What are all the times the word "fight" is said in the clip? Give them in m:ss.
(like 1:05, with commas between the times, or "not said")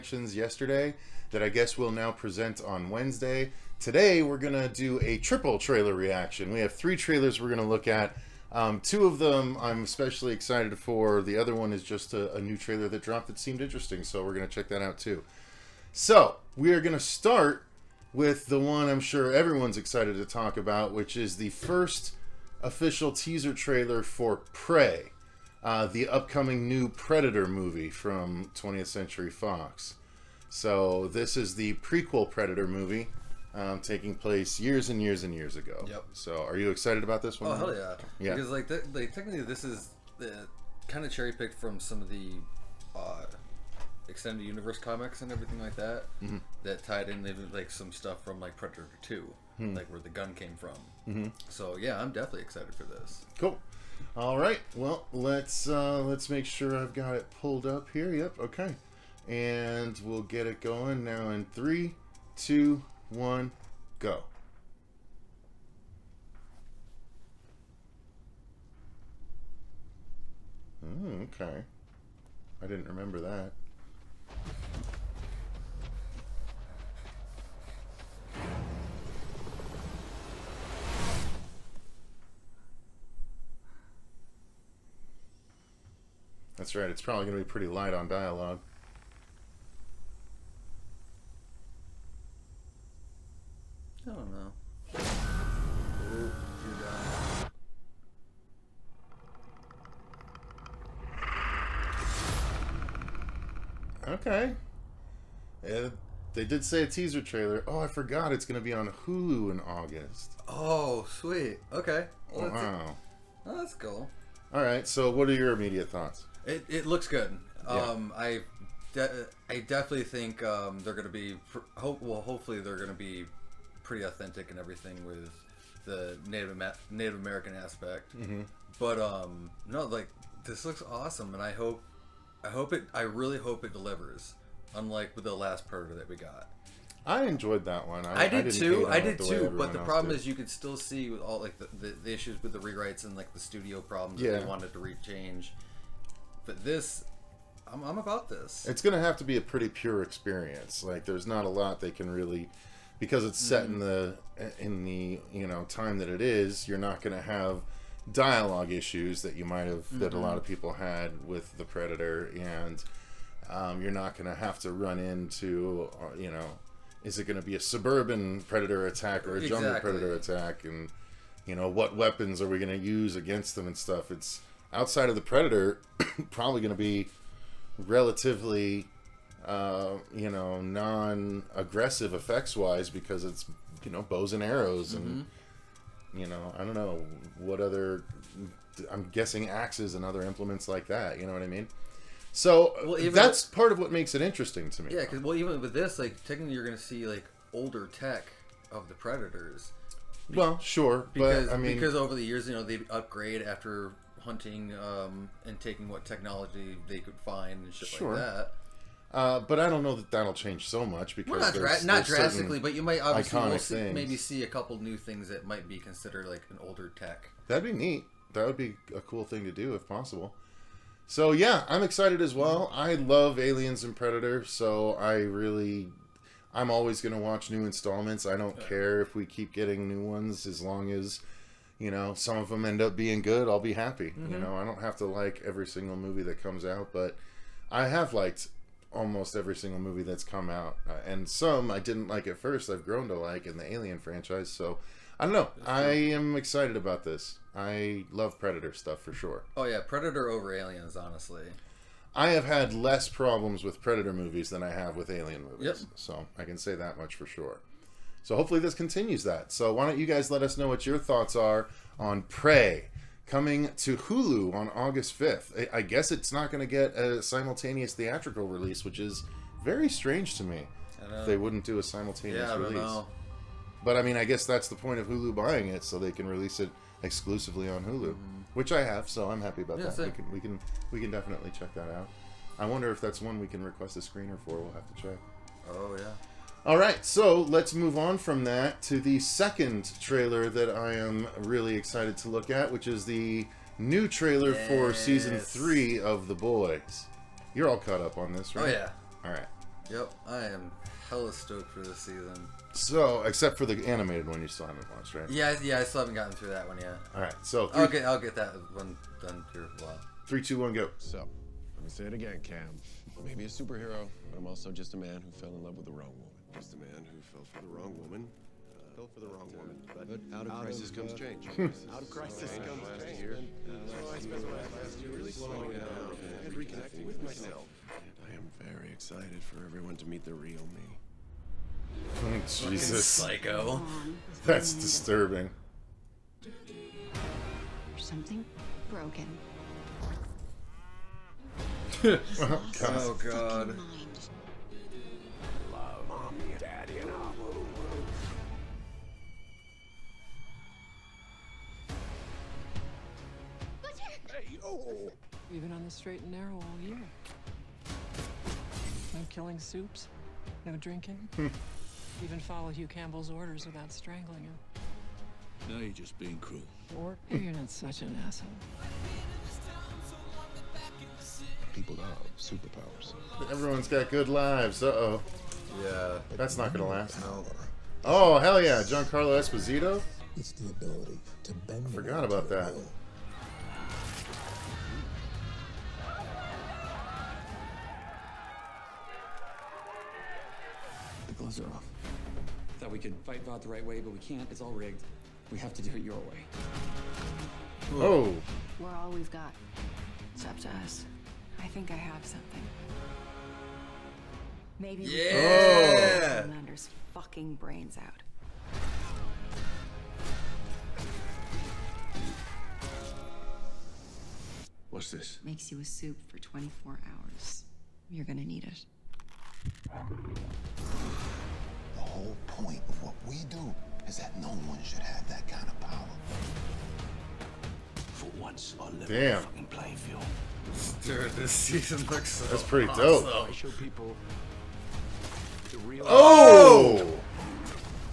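6:33.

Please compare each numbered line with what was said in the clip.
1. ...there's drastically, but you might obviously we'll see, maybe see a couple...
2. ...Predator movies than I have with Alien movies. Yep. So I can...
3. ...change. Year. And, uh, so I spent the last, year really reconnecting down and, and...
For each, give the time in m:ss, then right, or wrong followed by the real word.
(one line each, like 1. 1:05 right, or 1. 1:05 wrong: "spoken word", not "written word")
1. 3:32 right
2. 4:13 right
3. 5:23 wrong: "slowing", not "reconnecting".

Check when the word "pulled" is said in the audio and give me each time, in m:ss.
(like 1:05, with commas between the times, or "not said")
0:57.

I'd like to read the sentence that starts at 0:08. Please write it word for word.
Um, two of them I'm especially excited for.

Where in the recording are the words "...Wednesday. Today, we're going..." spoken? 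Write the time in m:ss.
0:02.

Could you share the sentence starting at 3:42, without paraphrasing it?
I love Aliens and Predator, so I really, I'm always gonna watch new installments.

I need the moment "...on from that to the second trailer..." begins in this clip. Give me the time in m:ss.
4:47.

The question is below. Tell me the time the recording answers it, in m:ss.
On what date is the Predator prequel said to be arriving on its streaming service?
4:24.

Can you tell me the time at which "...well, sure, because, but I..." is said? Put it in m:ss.
3:20.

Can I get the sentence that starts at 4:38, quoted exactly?
which I have, so I'm happy about yeah, that.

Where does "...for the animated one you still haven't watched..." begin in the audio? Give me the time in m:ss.
5:03.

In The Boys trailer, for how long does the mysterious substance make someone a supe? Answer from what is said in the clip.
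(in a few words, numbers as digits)
24 hours.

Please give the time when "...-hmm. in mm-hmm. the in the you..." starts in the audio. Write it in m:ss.
2:33.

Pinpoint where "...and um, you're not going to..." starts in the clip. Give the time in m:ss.
2:42.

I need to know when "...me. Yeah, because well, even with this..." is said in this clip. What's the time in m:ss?
3:14.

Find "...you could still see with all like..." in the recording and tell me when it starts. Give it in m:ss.
2:20.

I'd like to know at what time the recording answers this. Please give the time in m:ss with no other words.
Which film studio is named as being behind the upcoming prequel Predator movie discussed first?
0:28.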